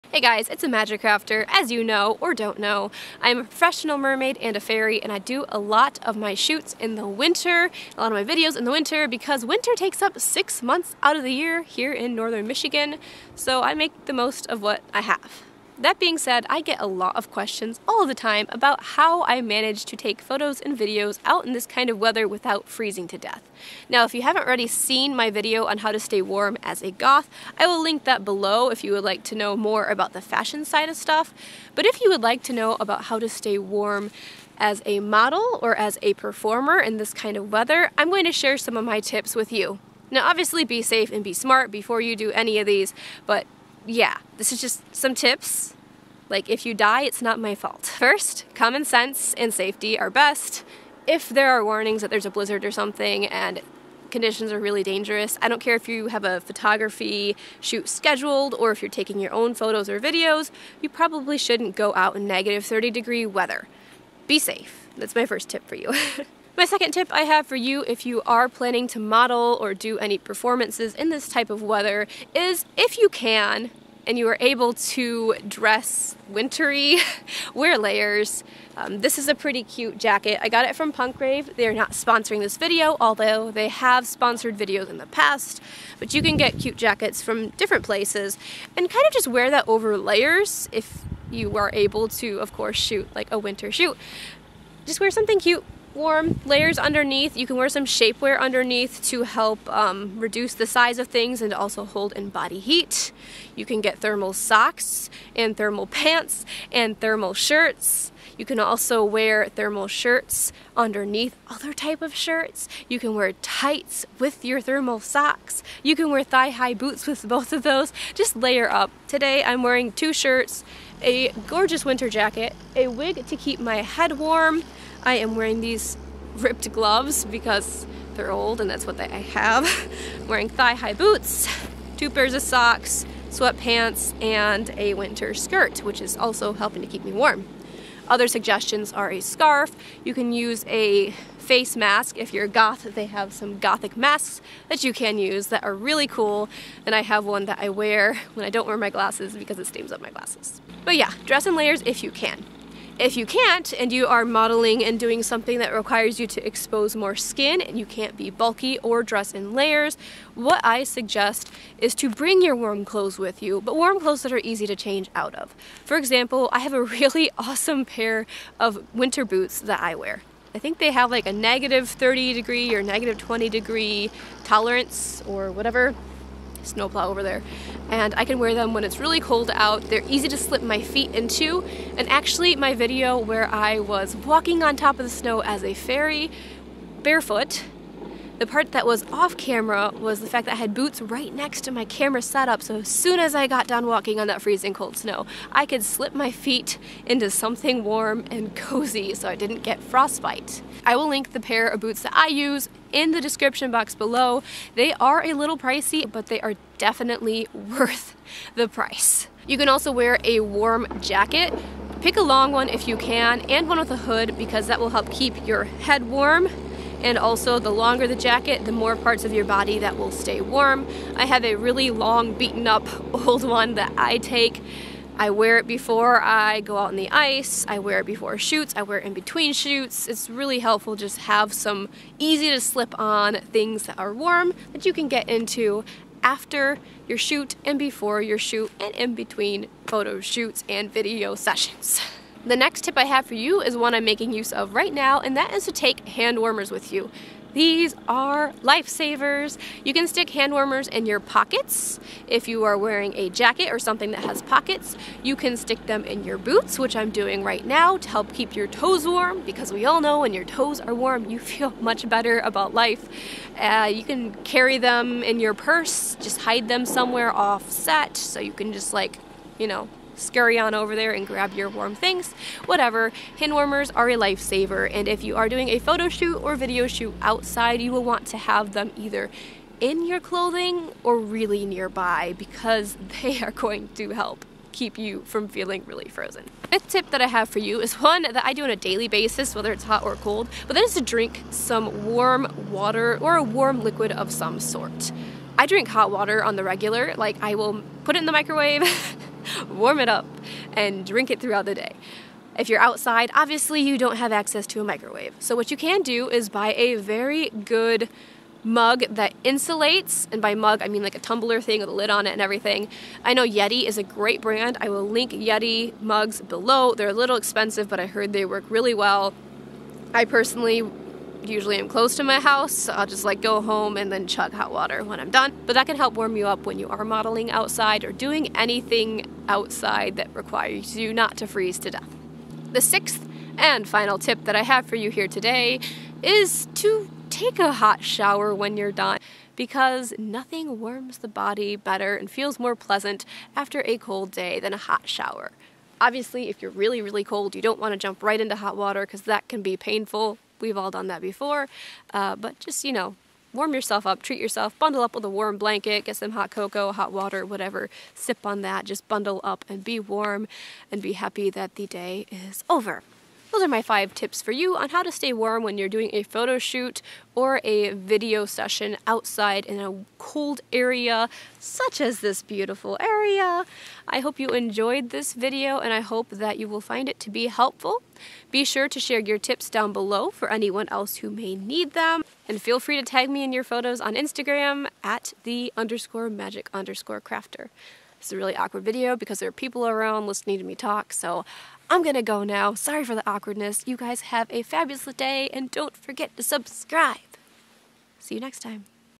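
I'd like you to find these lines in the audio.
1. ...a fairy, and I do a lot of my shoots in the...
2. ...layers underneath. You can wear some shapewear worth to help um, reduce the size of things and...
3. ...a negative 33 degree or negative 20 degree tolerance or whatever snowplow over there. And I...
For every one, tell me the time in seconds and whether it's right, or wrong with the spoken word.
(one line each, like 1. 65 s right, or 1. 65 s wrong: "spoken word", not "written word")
1. 4 s right
2. 96 s wrong: "underneath", not "worth"
3. 171 s wrong: "30", not "33".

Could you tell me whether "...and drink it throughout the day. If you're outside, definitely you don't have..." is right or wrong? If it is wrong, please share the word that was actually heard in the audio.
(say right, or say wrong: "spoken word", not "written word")
wrong: "obviously", not "definitely".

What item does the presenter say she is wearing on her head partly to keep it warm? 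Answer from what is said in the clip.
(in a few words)
A wig.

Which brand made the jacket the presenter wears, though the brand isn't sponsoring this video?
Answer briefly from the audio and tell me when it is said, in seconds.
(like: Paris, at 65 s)
Punkrave, at 80 s.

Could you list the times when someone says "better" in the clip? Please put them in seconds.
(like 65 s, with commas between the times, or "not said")
262 s, 341 s.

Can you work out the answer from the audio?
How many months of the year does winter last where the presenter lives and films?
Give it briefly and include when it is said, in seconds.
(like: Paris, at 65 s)
6, at 10 s.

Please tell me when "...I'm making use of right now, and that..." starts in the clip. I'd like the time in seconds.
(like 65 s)
243 s.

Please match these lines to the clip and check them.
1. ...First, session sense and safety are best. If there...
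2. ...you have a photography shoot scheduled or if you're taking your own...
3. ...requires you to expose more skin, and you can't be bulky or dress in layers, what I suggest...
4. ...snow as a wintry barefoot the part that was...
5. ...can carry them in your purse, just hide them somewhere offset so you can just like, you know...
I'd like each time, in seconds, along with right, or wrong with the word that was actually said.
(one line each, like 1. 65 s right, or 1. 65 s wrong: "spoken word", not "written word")
1. 47 s wrong: "common", not "session"
2. 55 s right
3. 155 s right
4. 185 s wrong: "fairy", not "wintry"
5. 264 s right.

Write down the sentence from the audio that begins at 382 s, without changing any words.
And feel free to tag me in your photos on Instagram at the underscore magic underscore crafter.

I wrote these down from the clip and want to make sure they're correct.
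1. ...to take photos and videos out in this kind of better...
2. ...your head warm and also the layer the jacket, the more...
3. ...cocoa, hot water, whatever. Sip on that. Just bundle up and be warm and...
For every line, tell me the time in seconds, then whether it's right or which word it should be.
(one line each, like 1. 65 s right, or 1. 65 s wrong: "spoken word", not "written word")
1. 19 s wrong: "weather", not "better"
2. 215 s wrong: "longer", not "layer"
3. 356 s right.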